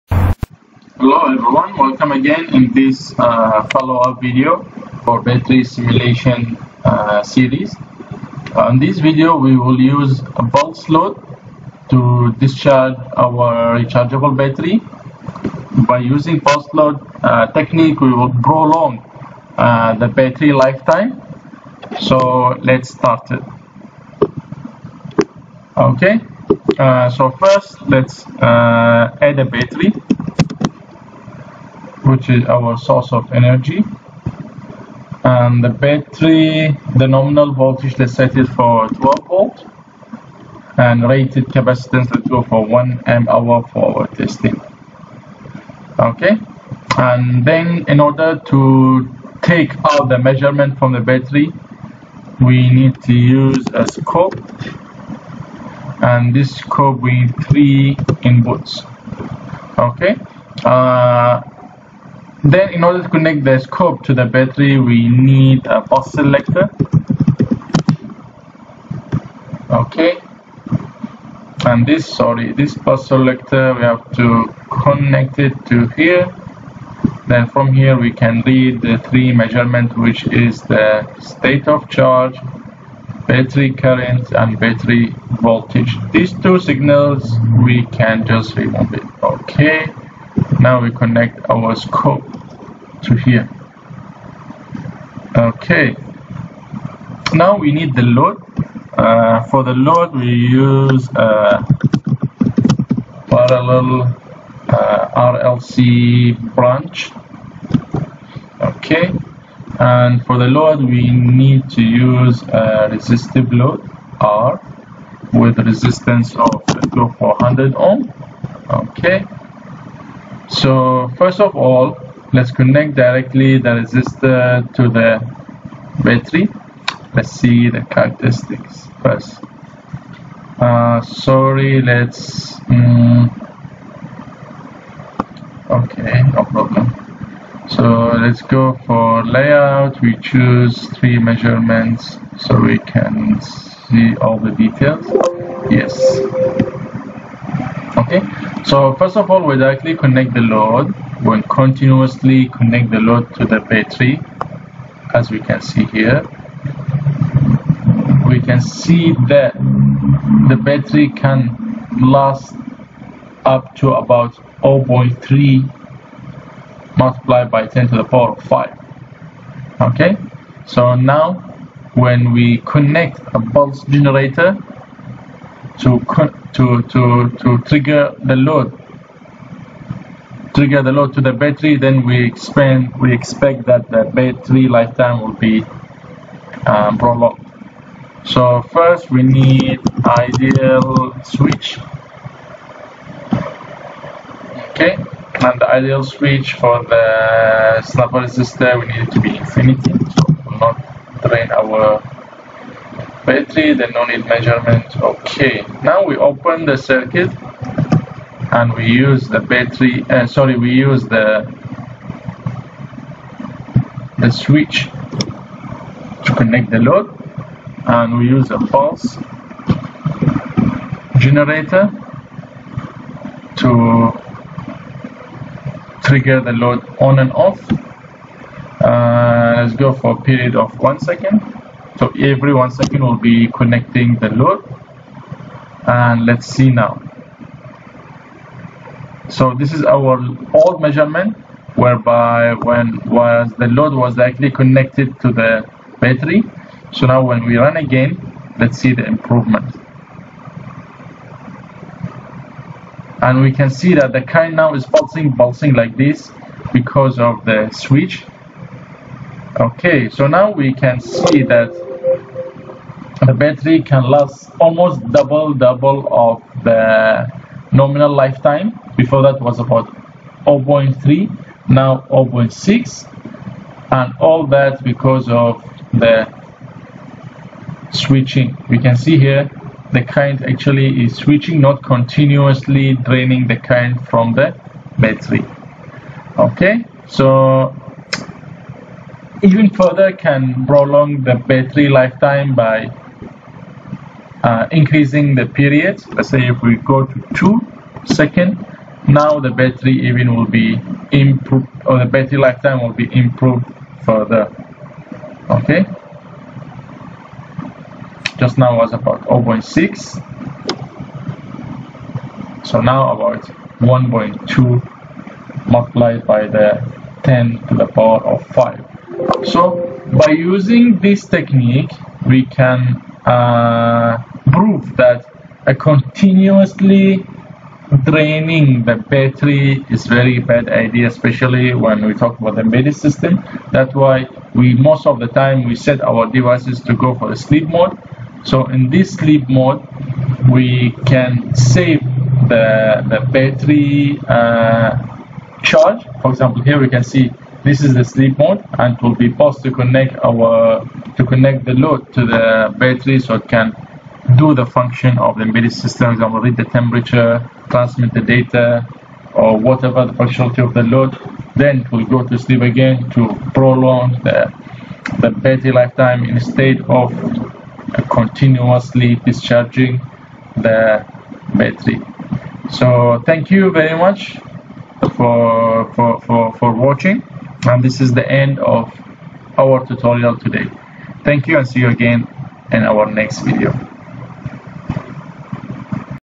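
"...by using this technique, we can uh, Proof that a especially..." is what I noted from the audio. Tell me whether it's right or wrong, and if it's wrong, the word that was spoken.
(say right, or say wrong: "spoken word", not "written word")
wrong: "continuously", not "especially".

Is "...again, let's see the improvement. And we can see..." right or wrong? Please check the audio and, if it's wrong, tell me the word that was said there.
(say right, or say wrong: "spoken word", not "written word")
right.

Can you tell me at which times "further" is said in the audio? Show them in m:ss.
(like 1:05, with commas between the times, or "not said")
4:49, 5:04.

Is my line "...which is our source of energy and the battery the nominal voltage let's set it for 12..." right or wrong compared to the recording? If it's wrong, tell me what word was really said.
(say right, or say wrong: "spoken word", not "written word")
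right.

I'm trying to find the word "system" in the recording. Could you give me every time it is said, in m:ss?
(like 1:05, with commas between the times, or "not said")
5:32, 5:55.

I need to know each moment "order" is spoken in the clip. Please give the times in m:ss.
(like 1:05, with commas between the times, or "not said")
0:48, 1:02.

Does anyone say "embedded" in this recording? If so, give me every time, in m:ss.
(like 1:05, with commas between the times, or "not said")
5:32, 5:55.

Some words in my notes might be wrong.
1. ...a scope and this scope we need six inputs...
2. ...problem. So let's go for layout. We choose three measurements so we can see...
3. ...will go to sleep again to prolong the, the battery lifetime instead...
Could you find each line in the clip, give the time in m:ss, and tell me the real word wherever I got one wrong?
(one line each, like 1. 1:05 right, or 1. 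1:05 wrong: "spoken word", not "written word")
1. 0:53 wrong: "three", not "six"
2. 2:16 right
3. 6:01 right.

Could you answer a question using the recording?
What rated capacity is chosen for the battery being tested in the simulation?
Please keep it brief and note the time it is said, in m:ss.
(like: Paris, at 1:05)
1 amp hour, at 0:42.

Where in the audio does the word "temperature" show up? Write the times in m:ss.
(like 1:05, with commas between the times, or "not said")
5:56.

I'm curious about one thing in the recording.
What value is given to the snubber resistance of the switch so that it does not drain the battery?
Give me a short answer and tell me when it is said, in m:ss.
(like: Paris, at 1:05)
infinity, at 3:19.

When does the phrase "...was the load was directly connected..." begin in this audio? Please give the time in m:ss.
4:03.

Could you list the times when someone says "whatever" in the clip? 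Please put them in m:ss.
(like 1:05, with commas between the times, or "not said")
5:59.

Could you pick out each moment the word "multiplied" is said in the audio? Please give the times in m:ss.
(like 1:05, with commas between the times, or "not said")
2:46, 5:15.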